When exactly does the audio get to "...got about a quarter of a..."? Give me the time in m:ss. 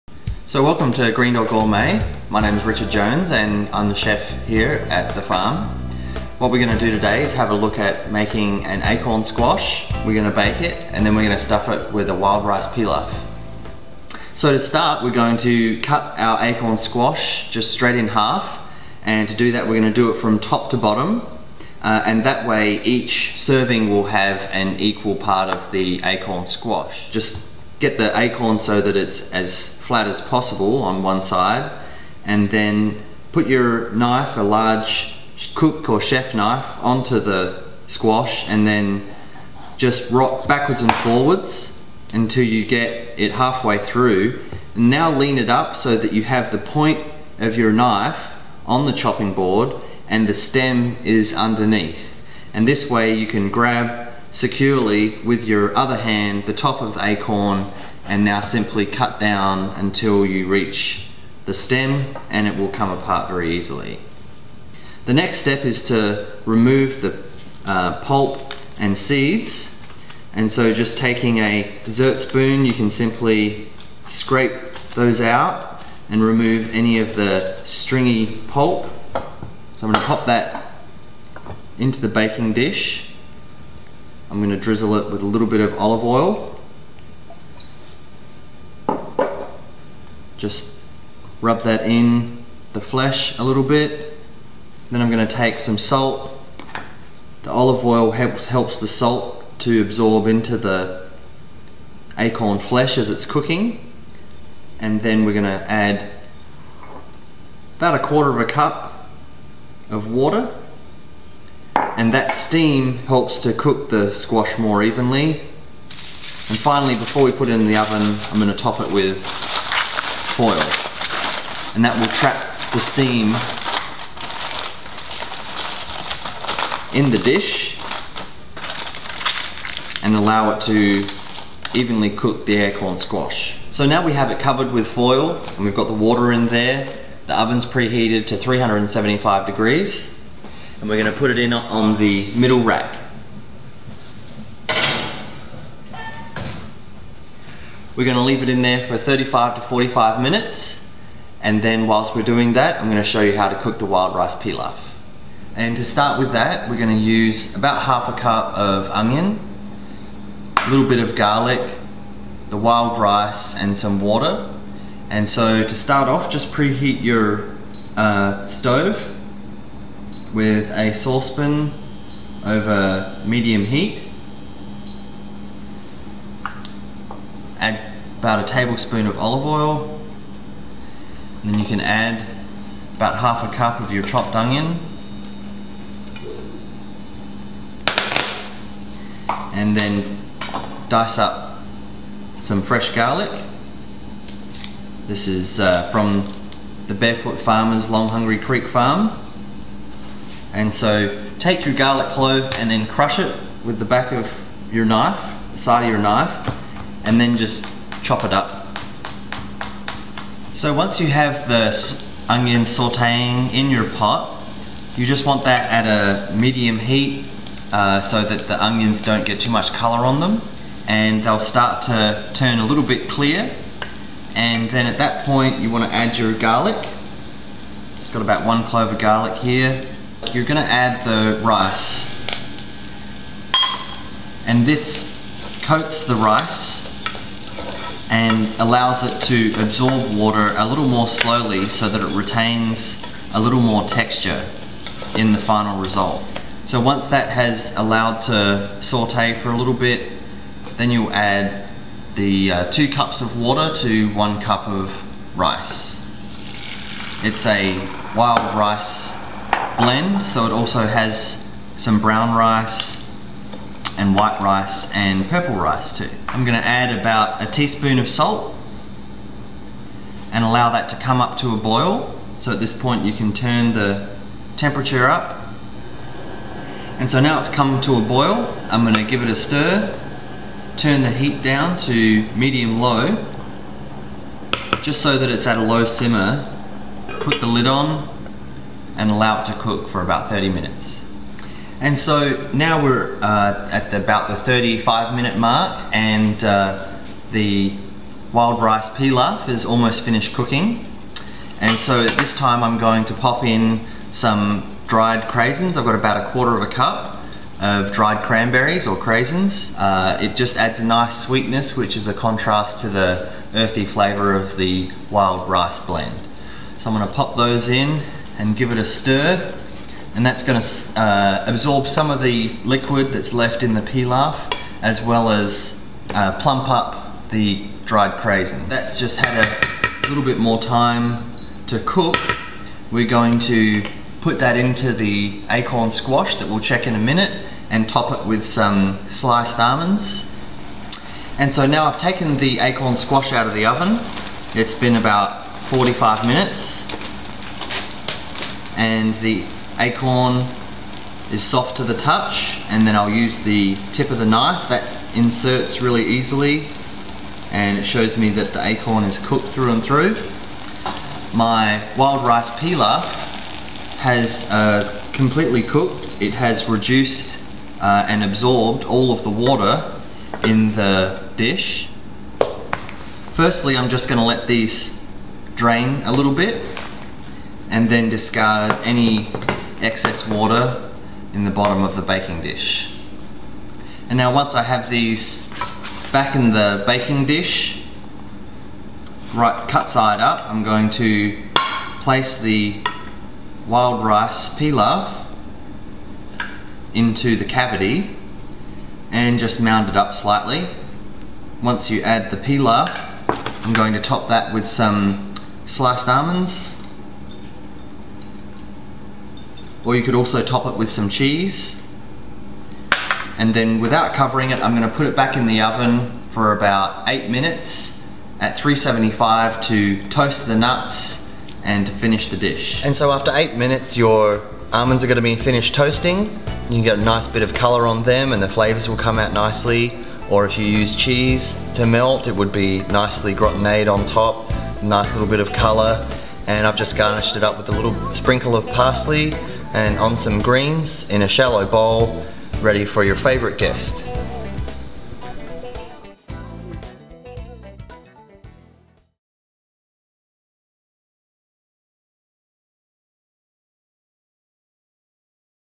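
5:05.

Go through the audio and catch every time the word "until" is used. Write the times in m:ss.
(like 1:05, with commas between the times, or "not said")
0:42, 0:59.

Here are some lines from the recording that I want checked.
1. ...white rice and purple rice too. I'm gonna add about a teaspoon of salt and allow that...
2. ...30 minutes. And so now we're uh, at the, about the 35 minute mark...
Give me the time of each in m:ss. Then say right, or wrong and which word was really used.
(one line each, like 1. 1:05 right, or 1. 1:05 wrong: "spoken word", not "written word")
1. 4:24 right
2. 4:50 right.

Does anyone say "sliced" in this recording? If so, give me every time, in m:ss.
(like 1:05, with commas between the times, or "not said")
5:39, 6:45.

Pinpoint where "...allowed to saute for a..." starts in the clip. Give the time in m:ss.
4:07.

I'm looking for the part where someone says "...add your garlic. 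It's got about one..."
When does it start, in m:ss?
3:45.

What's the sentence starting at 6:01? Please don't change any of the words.
My wild rice pilaf has uh, completely cooked.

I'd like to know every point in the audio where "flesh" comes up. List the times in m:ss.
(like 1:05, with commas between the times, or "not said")
1:32, 1:42.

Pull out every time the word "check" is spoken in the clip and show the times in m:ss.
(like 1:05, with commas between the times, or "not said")
5:36.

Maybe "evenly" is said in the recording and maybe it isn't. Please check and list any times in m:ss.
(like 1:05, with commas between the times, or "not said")
1:54, 2:11.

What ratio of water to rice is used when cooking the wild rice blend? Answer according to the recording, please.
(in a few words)
2 cups to 1 cup.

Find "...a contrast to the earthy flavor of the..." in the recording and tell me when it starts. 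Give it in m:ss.
5:12.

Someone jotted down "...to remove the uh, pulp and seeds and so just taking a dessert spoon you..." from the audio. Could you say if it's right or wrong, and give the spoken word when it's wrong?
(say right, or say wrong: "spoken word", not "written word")
right.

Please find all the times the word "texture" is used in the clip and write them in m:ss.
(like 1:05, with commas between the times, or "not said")
4:03.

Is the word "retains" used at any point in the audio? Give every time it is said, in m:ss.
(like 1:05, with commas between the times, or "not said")
4:02.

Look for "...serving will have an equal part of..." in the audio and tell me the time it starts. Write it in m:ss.
0:23.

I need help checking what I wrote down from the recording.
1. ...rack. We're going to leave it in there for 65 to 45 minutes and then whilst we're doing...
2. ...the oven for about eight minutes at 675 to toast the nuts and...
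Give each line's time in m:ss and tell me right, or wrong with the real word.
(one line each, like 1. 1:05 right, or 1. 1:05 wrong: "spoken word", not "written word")
1. 2:22 wrong: "35", not "65"
2. 6:55 wrong: "375", not "675".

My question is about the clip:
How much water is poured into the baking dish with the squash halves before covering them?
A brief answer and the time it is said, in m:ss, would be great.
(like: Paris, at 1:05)
1/4 cup, at 1:47.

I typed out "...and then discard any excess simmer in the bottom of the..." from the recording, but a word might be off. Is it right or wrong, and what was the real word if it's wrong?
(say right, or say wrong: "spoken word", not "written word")
wrong: "water", not "simmer".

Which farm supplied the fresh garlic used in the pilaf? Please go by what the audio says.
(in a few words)
Long Hungry Creek Farm.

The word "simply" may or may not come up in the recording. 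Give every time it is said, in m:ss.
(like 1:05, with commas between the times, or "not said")
0:58, 1:12.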